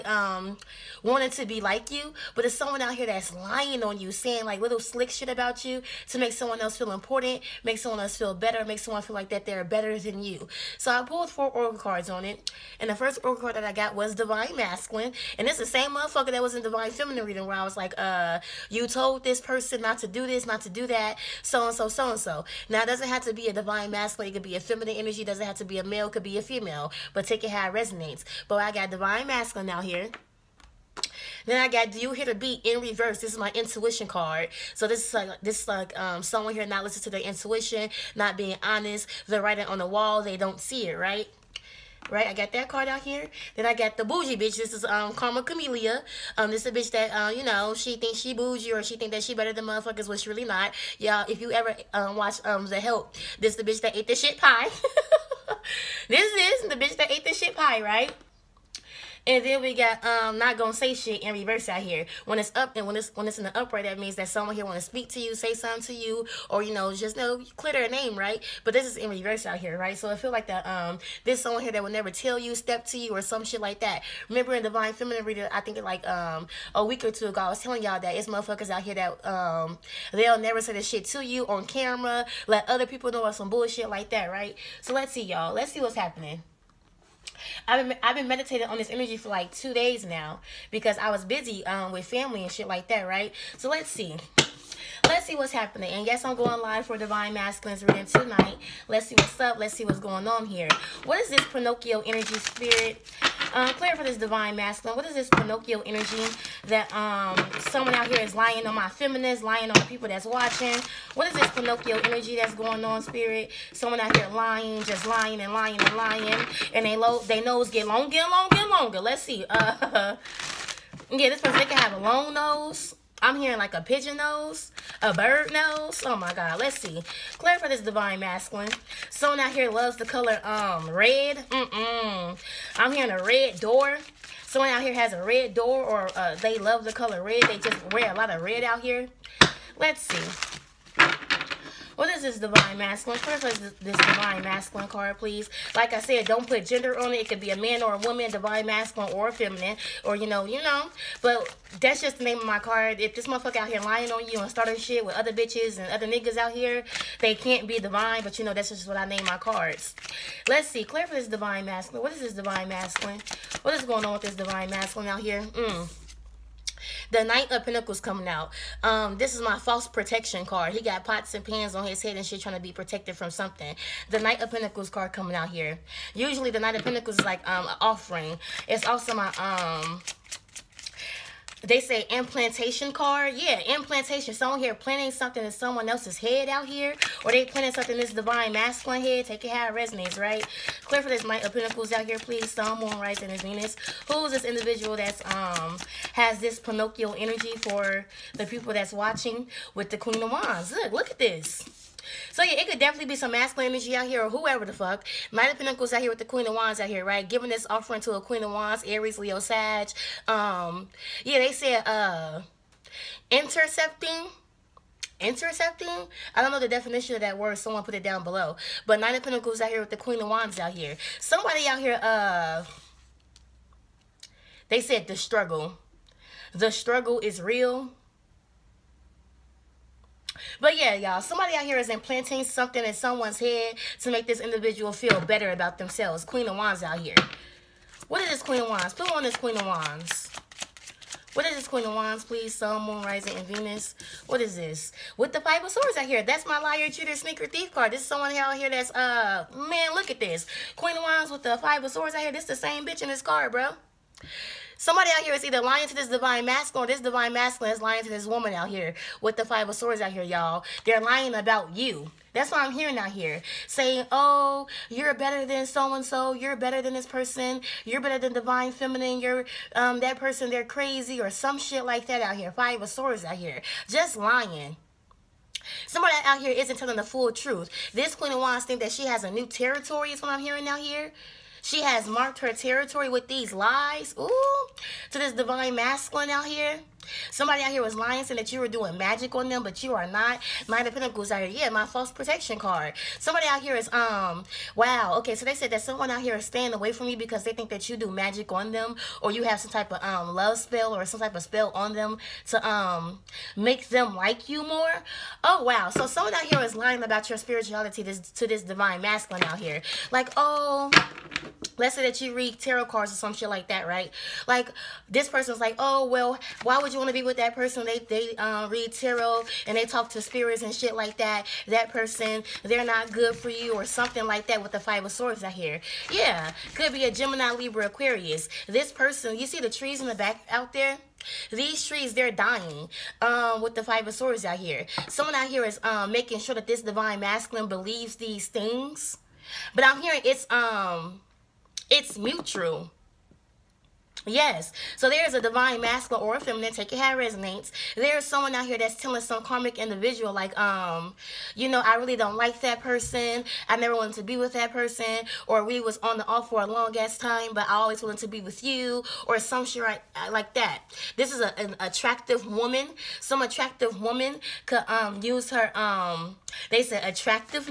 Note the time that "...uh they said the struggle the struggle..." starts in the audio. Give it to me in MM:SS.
03:42.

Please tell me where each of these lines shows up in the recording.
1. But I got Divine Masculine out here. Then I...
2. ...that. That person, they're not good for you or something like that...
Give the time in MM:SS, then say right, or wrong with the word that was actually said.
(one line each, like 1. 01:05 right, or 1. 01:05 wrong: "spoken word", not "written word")
1. 00:28 right
2. 05:21 right.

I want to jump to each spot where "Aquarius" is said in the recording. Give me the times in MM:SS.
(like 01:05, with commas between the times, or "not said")
05:27.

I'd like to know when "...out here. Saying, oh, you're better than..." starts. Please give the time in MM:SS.
04:22.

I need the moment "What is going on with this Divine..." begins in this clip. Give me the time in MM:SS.
02:43.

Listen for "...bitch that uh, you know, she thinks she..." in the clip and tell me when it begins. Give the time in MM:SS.
00:46.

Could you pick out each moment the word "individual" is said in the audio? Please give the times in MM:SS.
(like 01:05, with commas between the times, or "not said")
03:14, 03:54, 05:49.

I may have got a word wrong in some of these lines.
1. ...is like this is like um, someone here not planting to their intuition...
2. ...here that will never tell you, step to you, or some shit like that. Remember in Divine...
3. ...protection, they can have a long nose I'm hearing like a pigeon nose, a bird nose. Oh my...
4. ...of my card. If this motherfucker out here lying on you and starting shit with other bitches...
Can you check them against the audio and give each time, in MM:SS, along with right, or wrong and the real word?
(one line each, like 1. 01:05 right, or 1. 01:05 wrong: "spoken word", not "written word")
1. 00:35 wrong: "listening", not "planting"
2. 01:11 right
3. 02:01 wrong: "person", not "protection"
4. 02:32 right.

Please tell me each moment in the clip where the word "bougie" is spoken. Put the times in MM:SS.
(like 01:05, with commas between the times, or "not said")
00:44, 00:48.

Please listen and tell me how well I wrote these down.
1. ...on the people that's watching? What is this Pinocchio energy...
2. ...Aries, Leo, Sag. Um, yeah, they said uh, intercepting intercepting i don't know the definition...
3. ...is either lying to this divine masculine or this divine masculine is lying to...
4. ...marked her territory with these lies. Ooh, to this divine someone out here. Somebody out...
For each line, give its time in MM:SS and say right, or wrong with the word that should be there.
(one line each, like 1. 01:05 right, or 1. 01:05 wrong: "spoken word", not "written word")
1. 01:49 right
2. 03:28 right
3. 04:15 right
4. 04:42 wrong: "masculine", not "someone".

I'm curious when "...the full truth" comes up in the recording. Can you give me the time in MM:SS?
04:36.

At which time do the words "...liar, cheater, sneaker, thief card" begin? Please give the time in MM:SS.
04:06.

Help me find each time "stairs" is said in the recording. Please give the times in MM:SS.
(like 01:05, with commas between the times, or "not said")
not said.